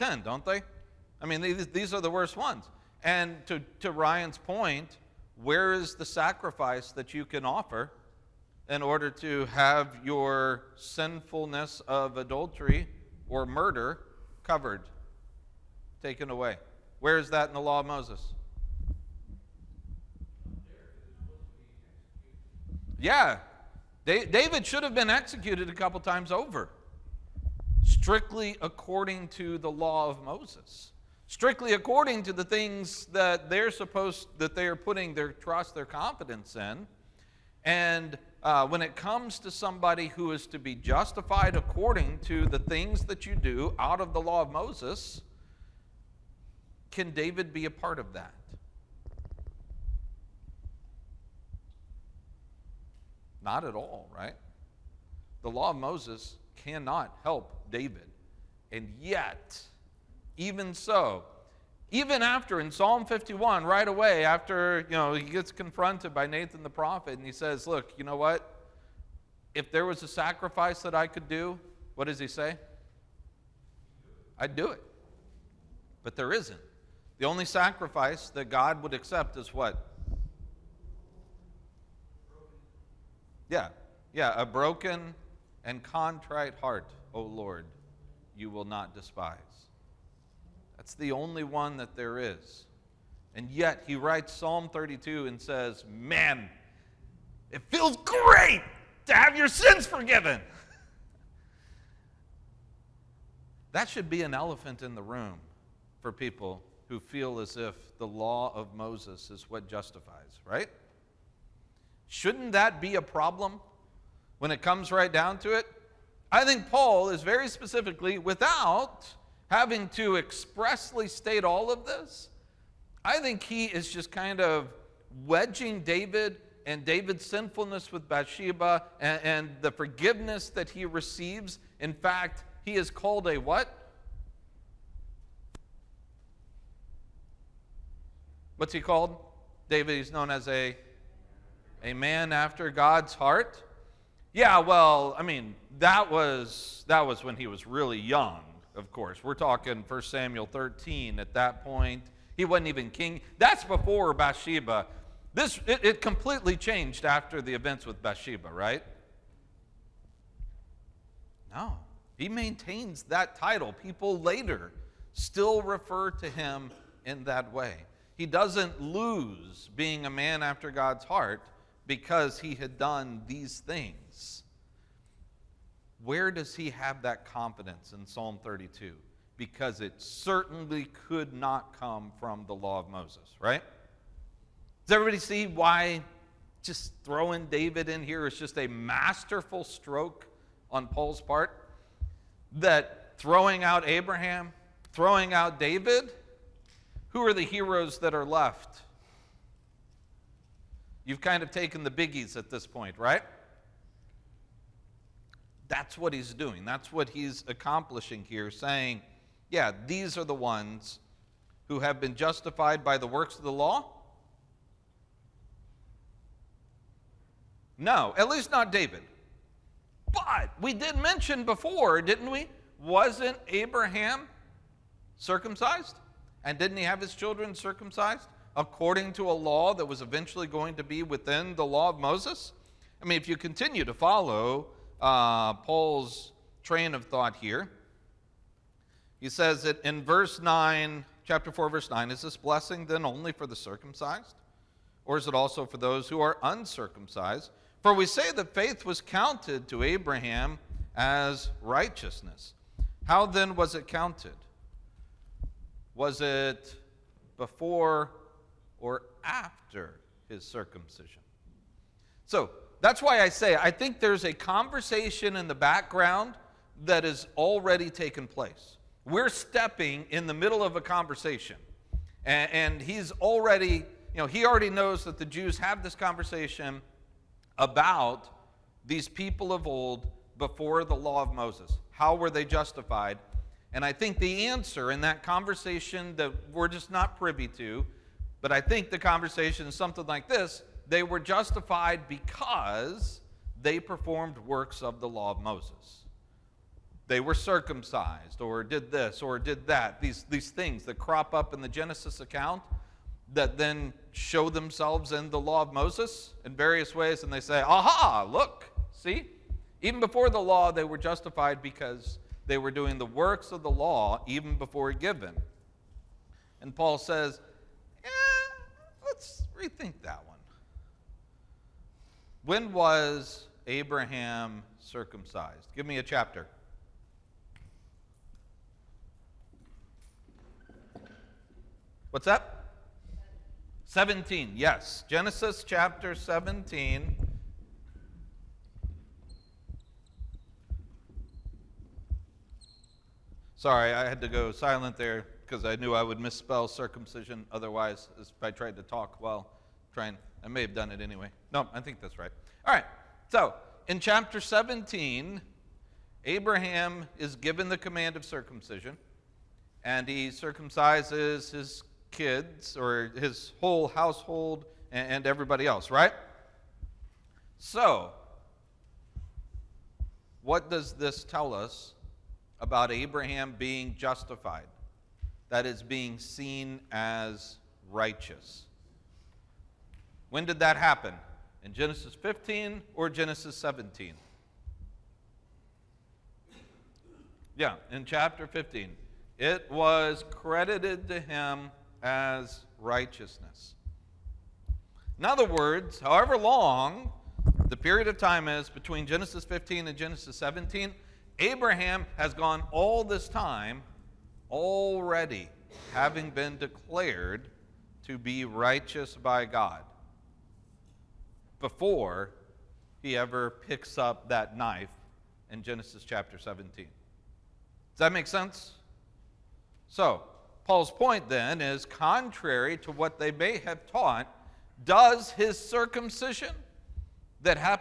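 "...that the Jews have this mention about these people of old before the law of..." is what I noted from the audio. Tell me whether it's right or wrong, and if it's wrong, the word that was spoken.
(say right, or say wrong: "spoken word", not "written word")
wrong: "conversation", not "mention".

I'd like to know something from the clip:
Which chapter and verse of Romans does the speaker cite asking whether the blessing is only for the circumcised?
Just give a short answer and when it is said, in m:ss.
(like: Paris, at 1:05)
Chapter 4, verse 9, at 4:01.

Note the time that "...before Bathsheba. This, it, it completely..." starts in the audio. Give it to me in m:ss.
2:33.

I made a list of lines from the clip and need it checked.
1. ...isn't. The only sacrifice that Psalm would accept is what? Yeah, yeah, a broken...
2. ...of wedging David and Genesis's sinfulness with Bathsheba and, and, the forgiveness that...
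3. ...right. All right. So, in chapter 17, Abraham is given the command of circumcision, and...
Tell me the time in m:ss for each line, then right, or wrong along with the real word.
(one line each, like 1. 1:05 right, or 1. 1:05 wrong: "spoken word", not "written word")
1. 1:16 wrong: "God", not "Psalm"
2. 2:04 wrong: "David", not "Genesis"
3. 5:52 right.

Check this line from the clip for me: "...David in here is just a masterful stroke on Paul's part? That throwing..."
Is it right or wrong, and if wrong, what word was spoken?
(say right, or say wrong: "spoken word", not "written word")
right.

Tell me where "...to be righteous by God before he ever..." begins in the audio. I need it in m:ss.
6:48.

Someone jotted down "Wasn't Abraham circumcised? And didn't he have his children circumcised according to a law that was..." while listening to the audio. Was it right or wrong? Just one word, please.
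right.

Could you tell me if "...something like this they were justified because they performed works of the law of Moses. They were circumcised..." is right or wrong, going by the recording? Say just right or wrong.
right.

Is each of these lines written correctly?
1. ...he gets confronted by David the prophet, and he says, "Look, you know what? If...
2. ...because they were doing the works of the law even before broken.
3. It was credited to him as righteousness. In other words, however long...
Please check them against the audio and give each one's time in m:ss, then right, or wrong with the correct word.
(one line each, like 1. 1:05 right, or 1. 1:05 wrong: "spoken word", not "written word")
1. 1:05 wrong: "Nathan", not "David"
2. 5:11 wrong: "given", not "broken"
3. 6:29 right.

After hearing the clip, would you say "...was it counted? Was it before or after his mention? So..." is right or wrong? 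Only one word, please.
wrong.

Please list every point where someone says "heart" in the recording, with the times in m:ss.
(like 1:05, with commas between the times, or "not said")
1:26, 2:23, 2:51.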